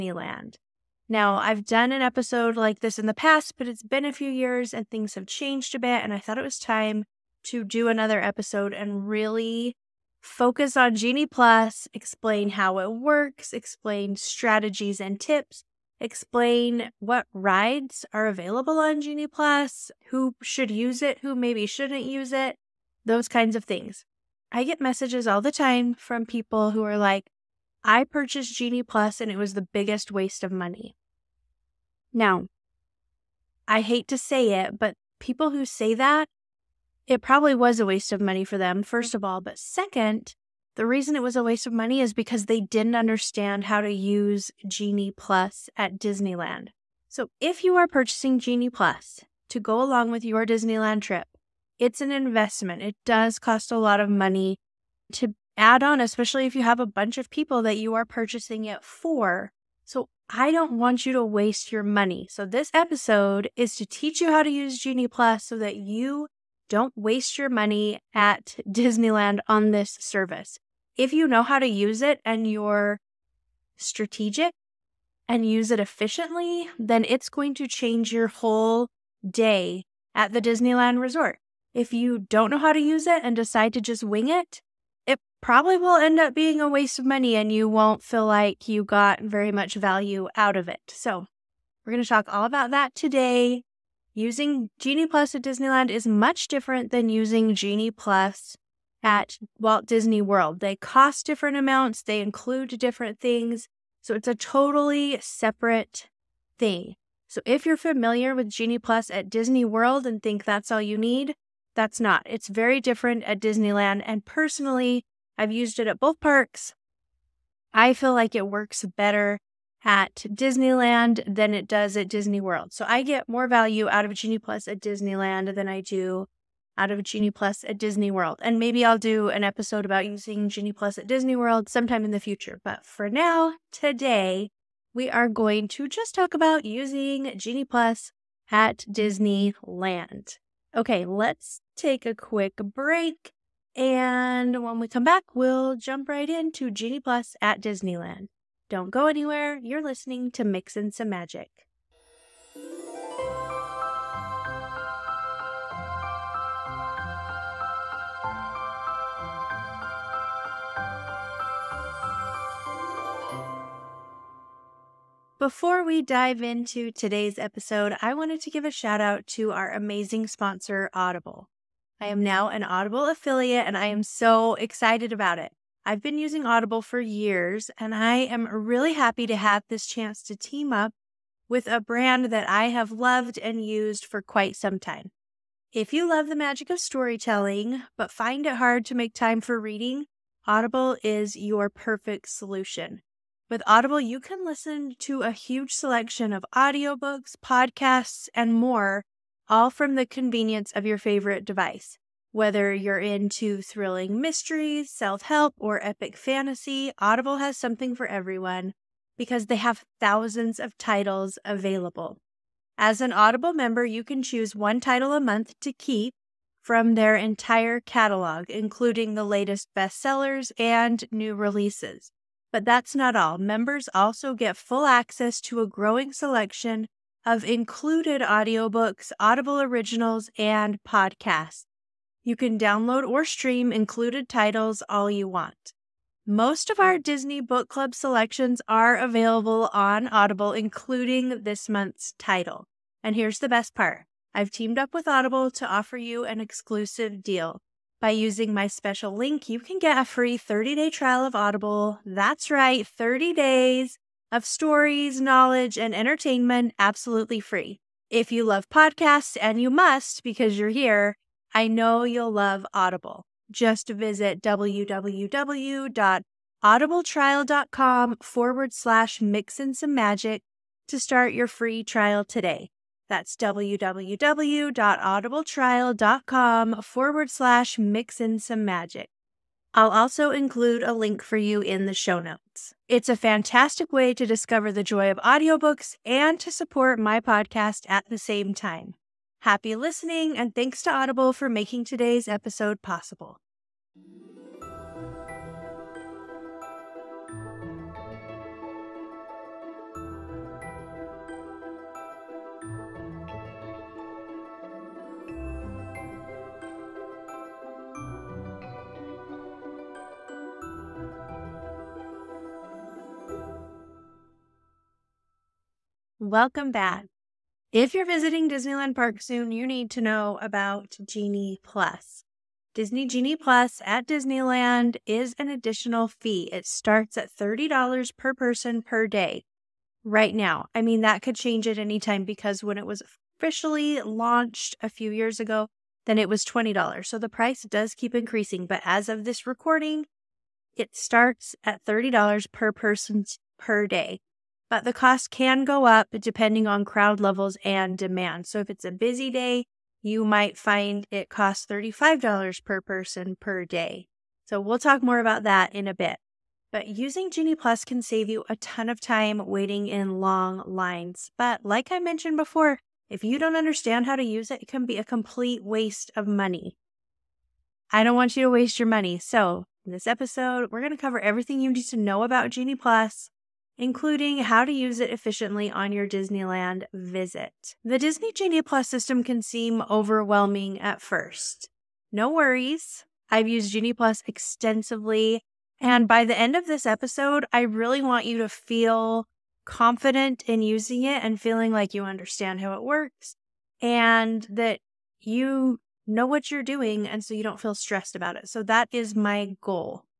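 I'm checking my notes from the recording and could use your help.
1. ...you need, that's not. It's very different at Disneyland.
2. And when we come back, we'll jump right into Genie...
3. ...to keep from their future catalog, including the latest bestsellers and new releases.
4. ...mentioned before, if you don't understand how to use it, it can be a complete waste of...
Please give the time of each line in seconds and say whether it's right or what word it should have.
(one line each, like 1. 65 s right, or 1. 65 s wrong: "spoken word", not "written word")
1. 110 s right
2. 143 s right
3. 215 s wrong: "entire", not "future"
4. 361 s right.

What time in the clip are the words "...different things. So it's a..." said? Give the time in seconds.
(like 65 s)
102 s.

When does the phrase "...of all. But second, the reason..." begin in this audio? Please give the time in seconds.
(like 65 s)
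39 s.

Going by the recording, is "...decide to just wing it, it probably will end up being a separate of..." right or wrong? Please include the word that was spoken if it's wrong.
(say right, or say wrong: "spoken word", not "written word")
wrong: "waste", not "separate".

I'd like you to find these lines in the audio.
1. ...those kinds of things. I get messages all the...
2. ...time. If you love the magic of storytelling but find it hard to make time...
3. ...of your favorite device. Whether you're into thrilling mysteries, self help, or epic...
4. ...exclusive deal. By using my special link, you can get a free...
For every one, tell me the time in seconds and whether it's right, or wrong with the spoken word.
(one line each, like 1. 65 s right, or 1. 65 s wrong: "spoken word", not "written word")
1. 23 s right
2. 184 s right
3. 200 s right
4. 246 s right.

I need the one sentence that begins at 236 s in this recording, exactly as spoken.
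Most of our Disney Book Club selections are available on Audible, including this month's title.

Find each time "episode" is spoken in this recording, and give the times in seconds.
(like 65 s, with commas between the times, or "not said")
2 s, 8 s, 62 s, 129 s, 167 s, 292 s, 370 s, 386 s.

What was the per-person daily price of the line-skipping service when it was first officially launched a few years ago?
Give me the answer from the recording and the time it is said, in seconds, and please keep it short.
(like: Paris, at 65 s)
$20, at 336 s.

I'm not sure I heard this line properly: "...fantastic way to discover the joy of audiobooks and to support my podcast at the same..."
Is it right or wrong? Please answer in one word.
right.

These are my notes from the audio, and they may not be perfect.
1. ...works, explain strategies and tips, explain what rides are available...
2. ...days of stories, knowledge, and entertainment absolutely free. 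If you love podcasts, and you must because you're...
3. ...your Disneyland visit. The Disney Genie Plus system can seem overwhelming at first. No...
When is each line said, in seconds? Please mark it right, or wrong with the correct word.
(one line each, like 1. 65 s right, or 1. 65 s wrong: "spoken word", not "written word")
1. 12 s right
2. 253 s right
3. 375 s right.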